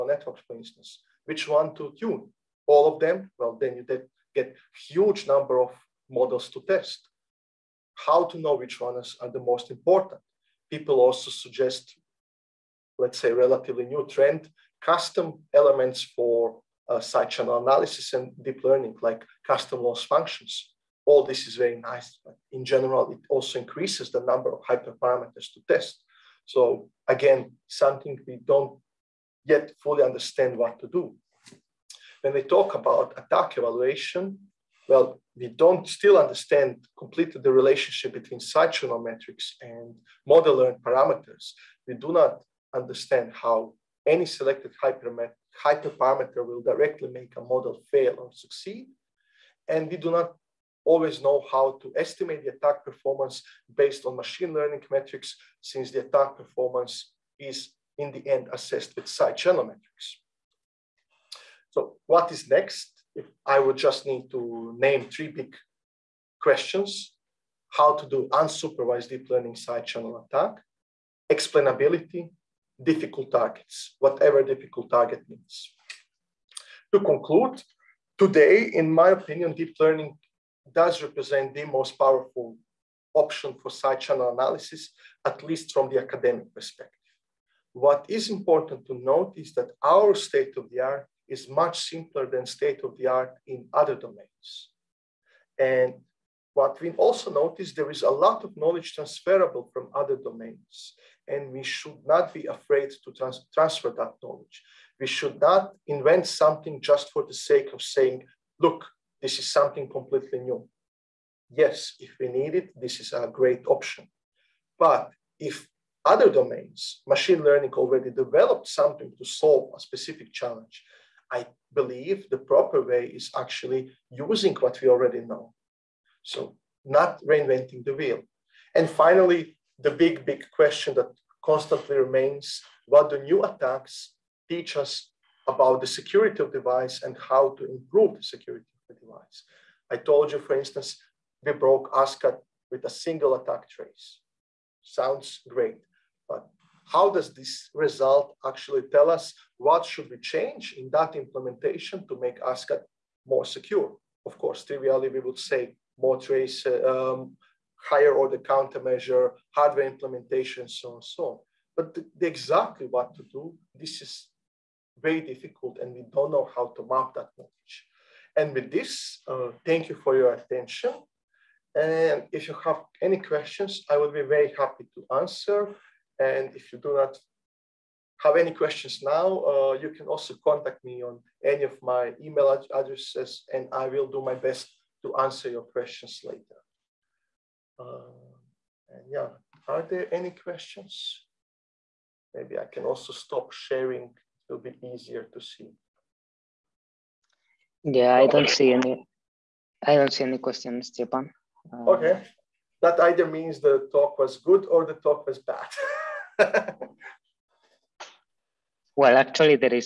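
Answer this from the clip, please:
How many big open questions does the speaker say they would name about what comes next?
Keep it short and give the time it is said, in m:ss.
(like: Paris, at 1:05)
3, at 1:05.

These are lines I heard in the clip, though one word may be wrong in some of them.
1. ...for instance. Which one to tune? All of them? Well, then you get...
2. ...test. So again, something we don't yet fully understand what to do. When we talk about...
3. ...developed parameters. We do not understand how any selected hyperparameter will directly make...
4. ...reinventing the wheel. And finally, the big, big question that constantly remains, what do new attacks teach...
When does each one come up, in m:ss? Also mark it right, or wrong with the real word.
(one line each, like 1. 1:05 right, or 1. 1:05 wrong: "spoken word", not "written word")
1. 0:00 right
2. 0:25 right
3. 0:40 wrong: "learned", not "developed"
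4. 2:07 right.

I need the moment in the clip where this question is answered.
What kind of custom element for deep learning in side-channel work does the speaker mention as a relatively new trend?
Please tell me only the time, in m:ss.
0:19.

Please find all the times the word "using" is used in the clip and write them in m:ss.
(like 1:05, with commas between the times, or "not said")
2:04.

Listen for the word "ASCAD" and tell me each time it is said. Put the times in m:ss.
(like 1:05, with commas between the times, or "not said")
2:21, 2:32.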